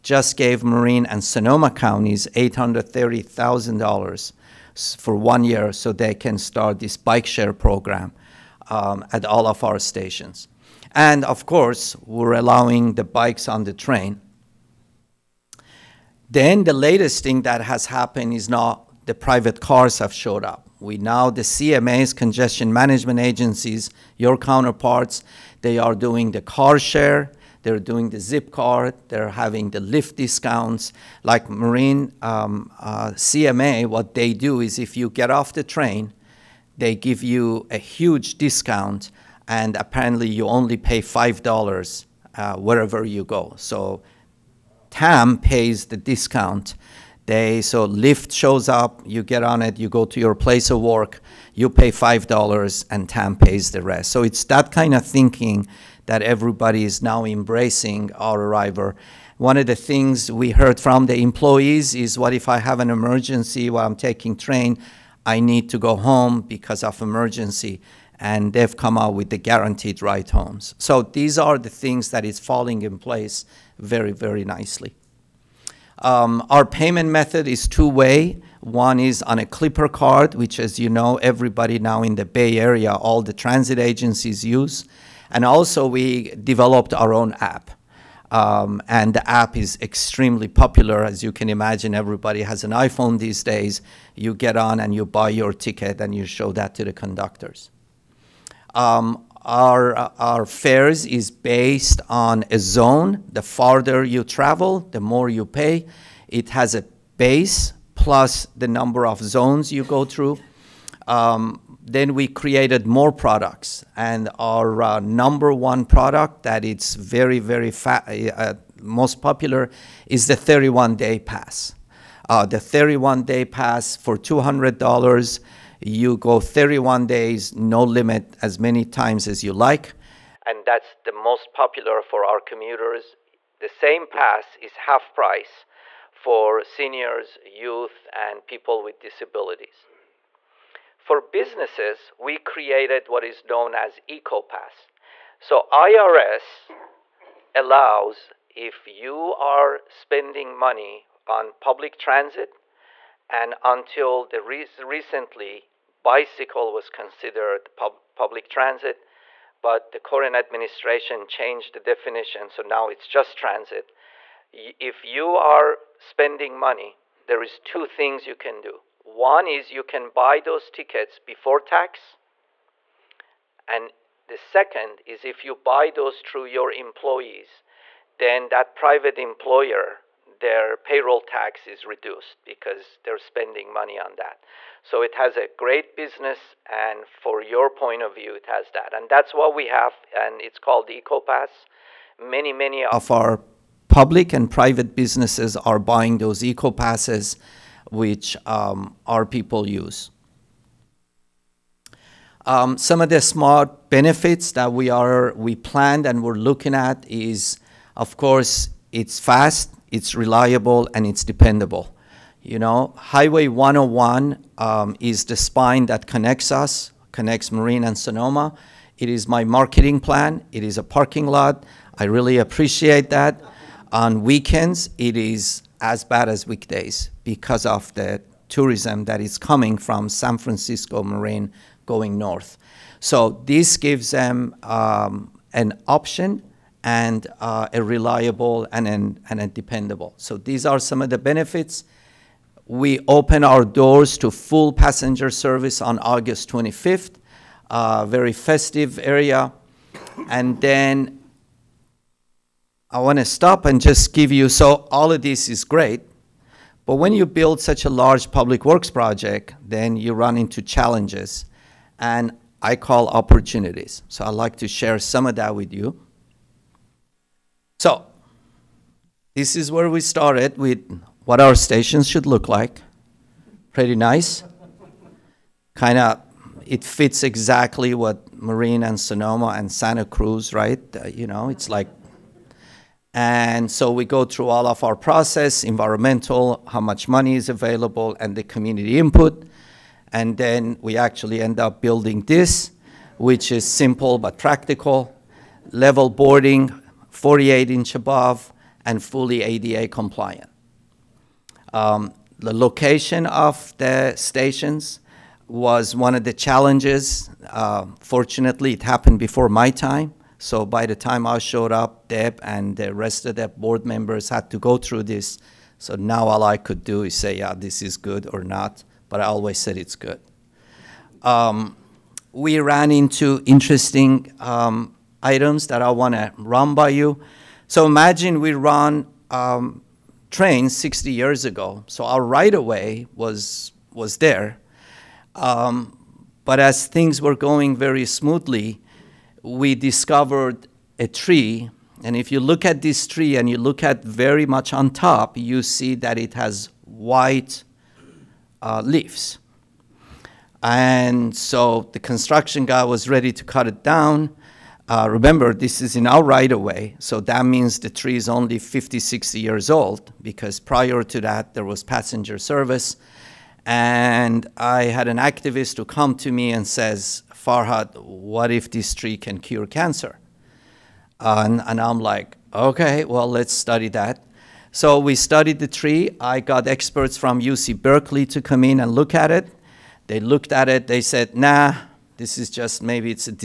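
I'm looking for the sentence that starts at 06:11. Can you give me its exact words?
Uh, and, and I'm like, okay, well, let's study that.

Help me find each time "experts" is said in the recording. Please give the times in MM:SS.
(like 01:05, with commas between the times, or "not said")
06:16.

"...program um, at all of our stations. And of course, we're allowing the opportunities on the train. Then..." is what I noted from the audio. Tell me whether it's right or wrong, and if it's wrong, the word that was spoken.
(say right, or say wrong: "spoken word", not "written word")
wrong: "bikes", not "opportunities".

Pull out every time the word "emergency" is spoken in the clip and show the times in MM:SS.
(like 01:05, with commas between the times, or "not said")
01:02, 01:07.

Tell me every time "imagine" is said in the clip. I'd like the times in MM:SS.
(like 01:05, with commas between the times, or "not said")
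01:31, 05:27.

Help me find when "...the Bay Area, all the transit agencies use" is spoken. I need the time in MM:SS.
01:22.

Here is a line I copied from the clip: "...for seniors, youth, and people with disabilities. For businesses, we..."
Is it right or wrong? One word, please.
right.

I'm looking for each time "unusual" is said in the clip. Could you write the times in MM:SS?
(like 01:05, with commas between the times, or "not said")
not said.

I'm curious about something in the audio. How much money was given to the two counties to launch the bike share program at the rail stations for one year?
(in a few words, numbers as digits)
$830,000.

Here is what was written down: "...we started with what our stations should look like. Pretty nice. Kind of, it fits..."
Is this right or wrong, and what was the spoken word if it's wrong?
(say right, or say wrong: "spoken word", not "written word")
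right.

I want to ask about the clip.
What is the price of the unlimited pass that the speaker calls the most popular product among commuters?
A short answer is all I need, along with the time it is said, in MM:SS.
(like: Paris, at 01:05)
$200, at 02:04.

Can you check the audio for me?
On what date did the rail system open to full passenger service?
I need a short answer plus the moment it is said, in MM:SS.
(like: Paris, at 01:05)
August 25th, at 04:05.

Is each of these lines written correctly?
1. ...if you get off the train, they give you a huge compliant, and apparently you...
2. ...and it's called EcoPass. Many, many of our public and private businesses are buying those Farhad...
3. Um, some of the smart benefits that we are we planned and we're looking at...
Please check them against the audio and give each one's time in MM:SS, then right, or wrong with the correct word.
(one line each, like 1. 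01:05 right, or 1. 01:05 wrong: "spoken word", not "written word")
1. 00:34 wrong: "discount", not "compliant"
2. 03:10 wrong: "EcoPasses", not "Farhad"
3. 03:22 right.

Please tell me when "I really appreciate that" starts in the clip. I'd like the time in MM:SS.
03:41.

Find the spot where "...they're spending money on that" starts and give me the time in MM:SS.
03:02.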